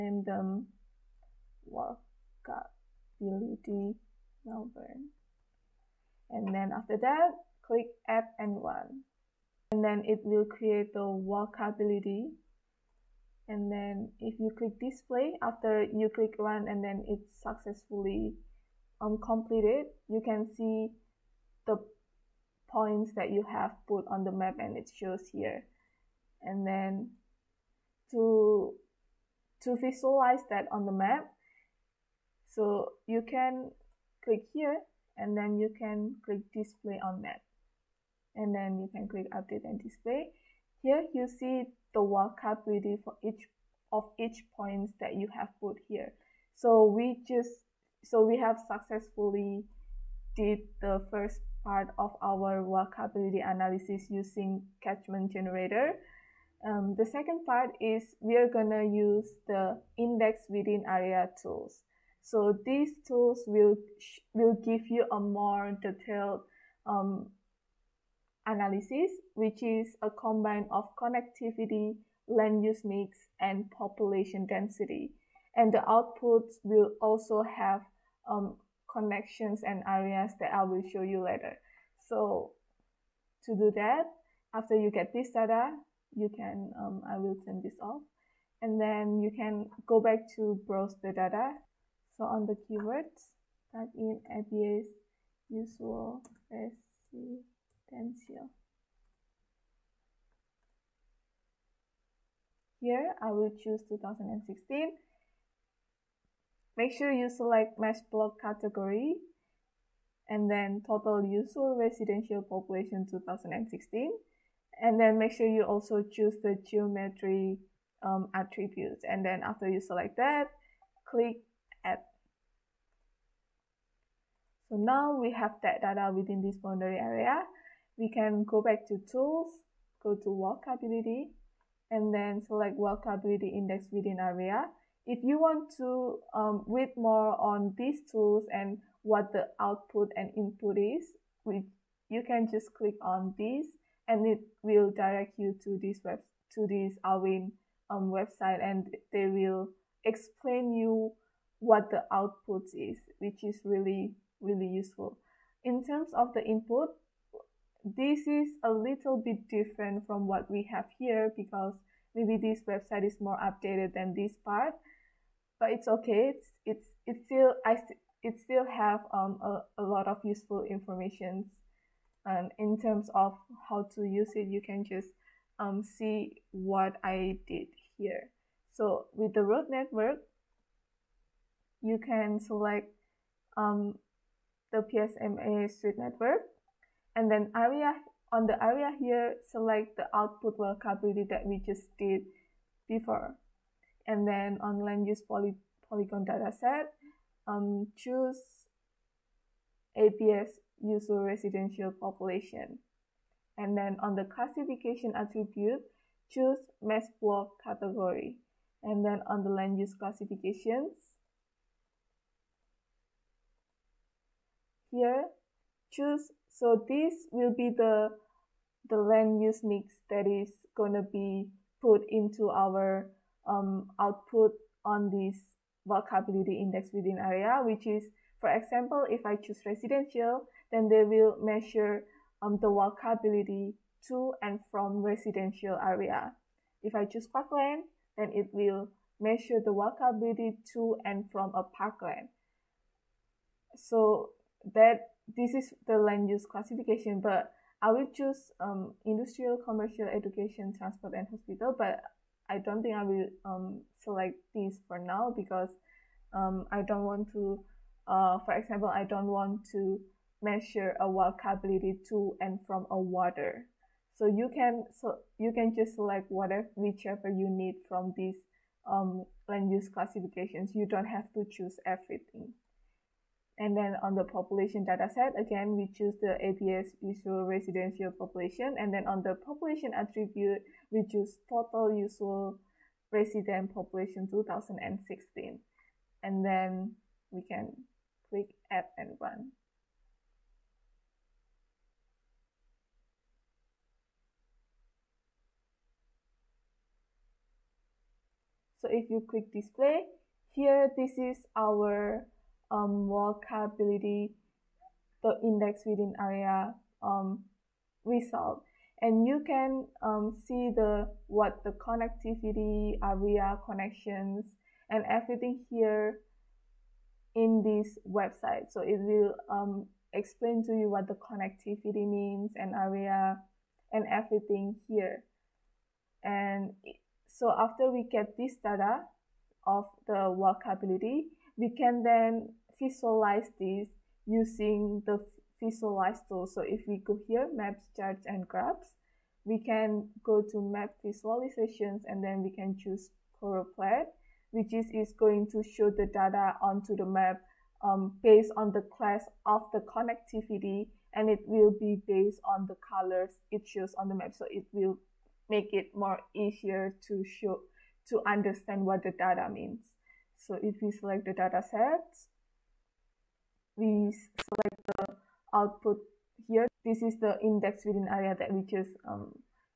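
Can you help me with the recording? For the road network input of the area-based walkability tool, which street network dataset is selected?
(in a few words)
PSMA street network.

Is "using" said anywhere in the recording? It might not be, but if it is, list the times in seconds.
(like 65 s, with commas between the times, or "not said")
54 s, 334 s.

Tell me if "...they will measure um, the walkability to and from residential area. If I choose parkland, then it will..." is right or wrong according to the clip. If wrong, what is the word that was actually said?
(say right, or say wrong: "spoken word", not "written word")
right.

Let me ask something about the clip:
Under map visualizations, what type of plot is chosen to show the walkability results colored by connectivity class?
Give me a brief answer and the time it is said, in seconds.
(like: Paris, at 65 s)
Color plot, at 343 s.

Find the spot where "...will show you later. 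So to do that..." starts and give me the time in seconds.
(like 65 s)
80 s.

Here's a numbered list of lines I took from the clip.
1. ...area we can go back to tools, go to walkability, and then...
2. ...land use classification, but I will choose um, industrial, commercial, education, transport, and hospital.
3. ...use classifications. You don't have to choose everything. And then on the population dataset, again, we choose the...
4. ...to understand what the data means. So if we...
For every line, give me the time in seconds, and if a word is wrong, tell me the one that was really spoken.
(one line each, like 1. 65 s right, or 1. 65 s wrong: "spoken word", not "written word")
1. 126 s right
2. 245 s right
3. 269 s right
4. 358 s right.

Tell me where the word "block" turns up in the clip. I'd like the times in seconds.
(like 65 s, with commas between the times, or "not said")
108 s, 207 s.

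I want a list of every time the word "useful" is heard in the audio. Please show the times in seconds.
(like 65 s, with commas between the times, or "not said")
154 s, 170 s.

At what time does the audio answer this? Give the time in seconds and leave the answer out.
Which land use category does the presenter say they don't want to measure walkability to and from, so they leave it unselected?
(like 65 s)
262 s.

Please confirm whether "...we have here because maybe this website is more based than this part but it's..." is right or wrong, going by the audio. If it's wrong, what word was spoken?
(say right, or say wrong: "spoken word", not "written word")
wrong: "updated", not "based".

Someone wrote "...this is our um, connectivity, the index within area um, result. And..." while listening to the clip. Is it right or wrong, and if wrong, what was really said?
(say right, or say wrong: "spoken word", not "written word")
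wrong: "walkability", not "connectivity".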